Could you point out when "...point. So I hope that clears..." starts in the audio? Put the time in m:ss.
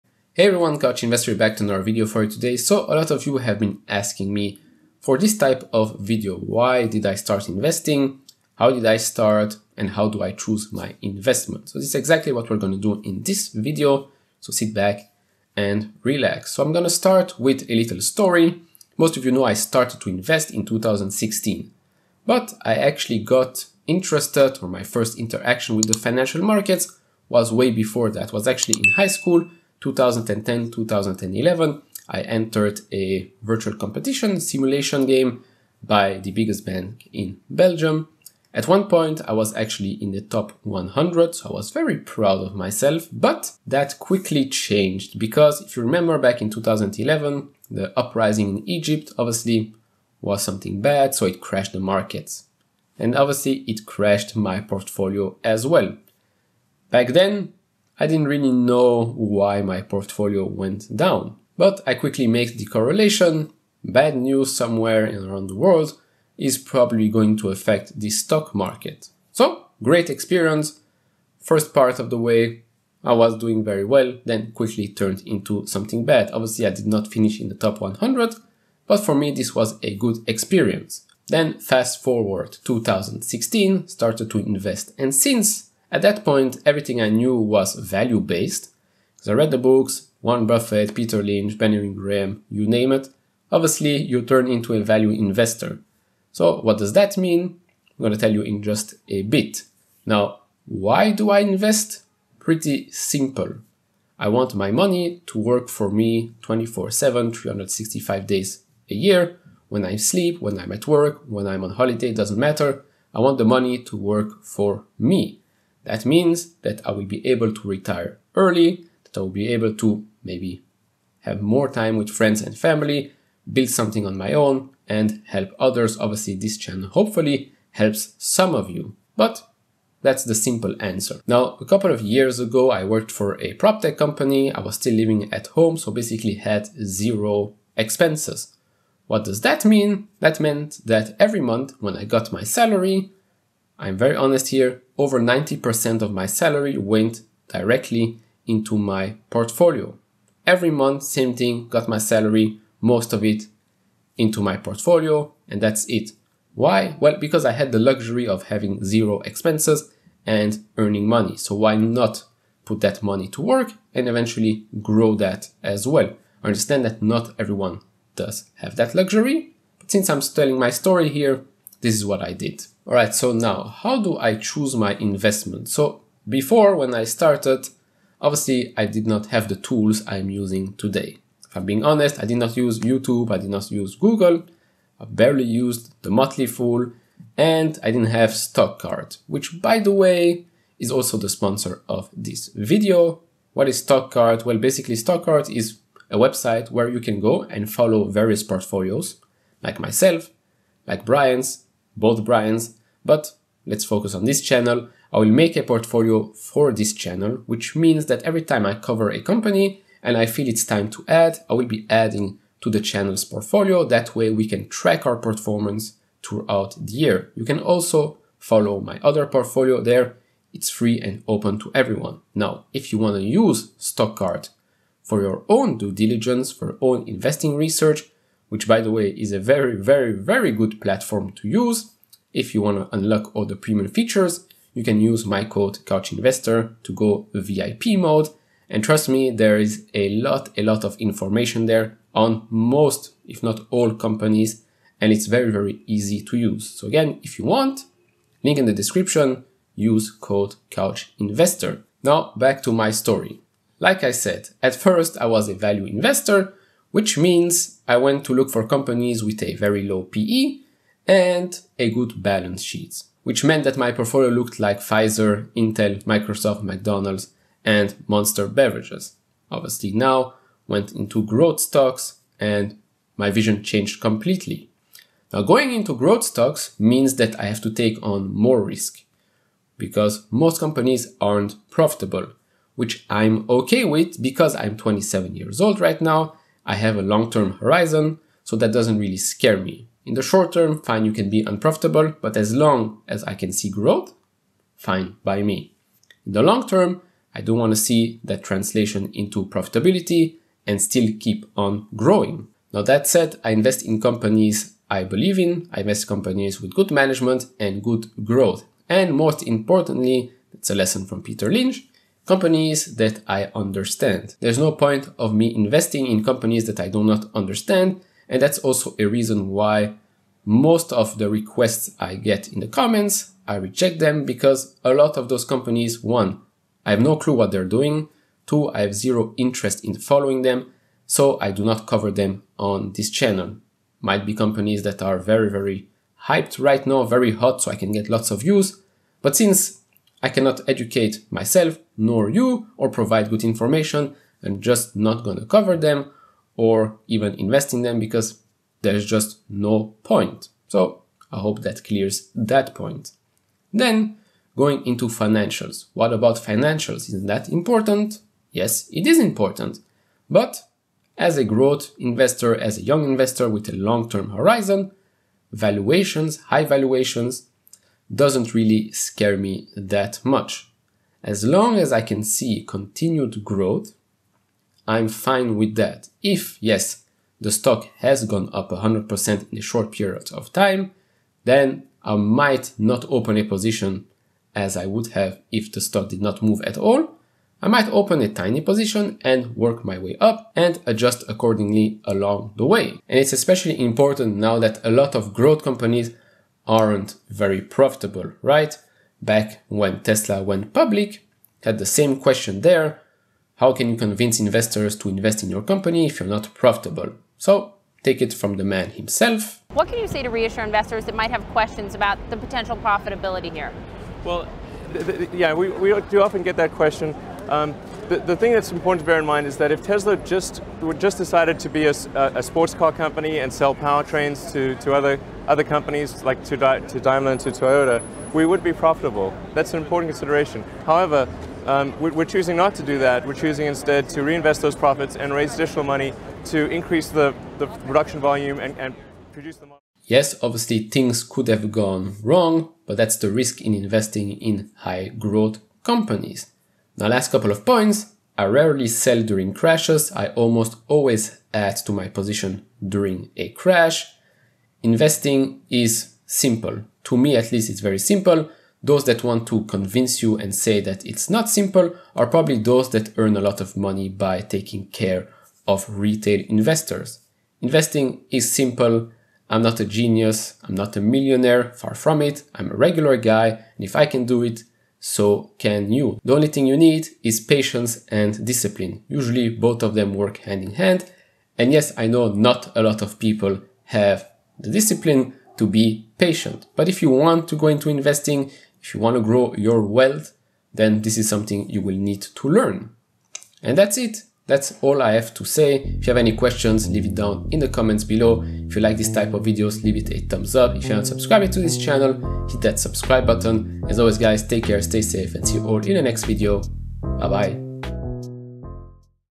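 5:50.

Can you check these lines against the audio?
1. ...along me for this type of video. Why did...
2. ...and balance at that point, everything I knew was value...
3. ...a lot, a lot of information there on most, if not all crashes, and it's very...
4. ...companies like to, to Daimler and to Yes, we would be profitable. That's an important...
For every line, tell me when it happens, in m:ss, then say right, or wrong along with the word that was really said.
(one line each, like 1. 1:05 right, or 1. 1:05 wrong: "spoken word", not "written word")
1. 0:03 wrong: "asking", not "along"
2. 1:24 wrong: "since", not "balance"
3. 3:59 wrong: "companies", not "crashes"
4. 7:05 wrong: "Toyota", not "Yes".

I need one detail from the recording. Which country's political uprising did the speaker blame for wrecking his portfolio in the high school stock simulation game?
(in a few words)
Egypt.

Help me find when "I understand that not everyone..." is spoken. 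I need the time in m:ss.
2:46.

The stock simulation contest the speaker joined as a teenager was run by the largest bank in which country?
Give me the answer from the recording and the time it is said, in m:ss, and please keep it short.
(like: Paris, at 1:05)
Belgium, at 0:37.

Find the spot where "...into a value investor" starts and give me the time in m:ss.
1:34.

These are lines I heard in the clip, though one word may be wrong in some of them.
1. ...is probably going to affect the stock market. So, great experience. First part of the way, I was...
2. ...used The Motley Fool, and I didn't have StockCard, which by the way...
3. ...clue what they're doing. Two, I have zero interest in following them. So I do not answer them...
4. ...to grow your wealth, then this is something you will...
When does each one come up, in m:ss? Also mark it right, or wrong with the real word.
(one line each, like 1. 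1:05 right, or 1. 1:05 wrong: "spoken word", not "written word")
1. 1:06 right
2. 3:05 right
3. 5:27 wrong: "cover", not "answer"
4. 8:09 right.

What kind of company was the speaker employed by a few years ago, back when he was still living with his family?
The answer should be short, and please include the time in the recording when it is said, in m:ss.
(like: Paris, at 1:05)
prop tech company, at 2:13.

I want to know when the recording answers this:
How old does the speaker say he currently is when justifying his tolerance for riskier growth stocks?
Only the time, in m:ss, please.
4:44.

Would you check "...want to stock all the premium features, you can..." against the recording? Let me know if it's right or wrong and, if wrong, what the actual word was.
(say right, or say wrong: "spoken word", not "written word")
wrong: "unlock", not "stock".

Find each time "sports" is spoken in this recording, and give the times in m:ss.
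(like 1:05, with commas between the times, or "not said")
7:02.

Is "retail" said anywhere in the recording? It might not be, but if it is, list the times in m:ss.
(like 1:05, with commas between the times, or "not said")
7:45.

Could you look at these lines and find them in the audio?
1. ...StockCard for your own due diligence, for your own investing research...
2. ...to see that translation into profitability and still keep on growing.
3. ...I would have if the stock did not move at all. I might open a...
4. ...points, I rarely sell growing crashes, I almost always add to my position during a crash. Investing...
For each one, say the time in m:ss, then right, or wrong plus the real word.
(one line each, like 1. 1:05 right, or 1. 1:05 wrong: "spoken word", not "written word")
1. 3:43 right
2. 4:57 right
3. 6:24 right
4. 7:27 wrong: "during", not "growing".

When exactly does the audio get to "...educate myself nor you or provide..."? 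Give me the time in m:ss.
5:40.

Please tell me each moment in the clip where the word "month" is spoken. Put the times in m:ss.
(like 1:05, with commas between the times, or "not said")
2:21, 2:30.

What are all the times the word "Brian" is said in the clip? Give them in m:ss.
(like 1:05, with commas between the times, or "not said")
3:21.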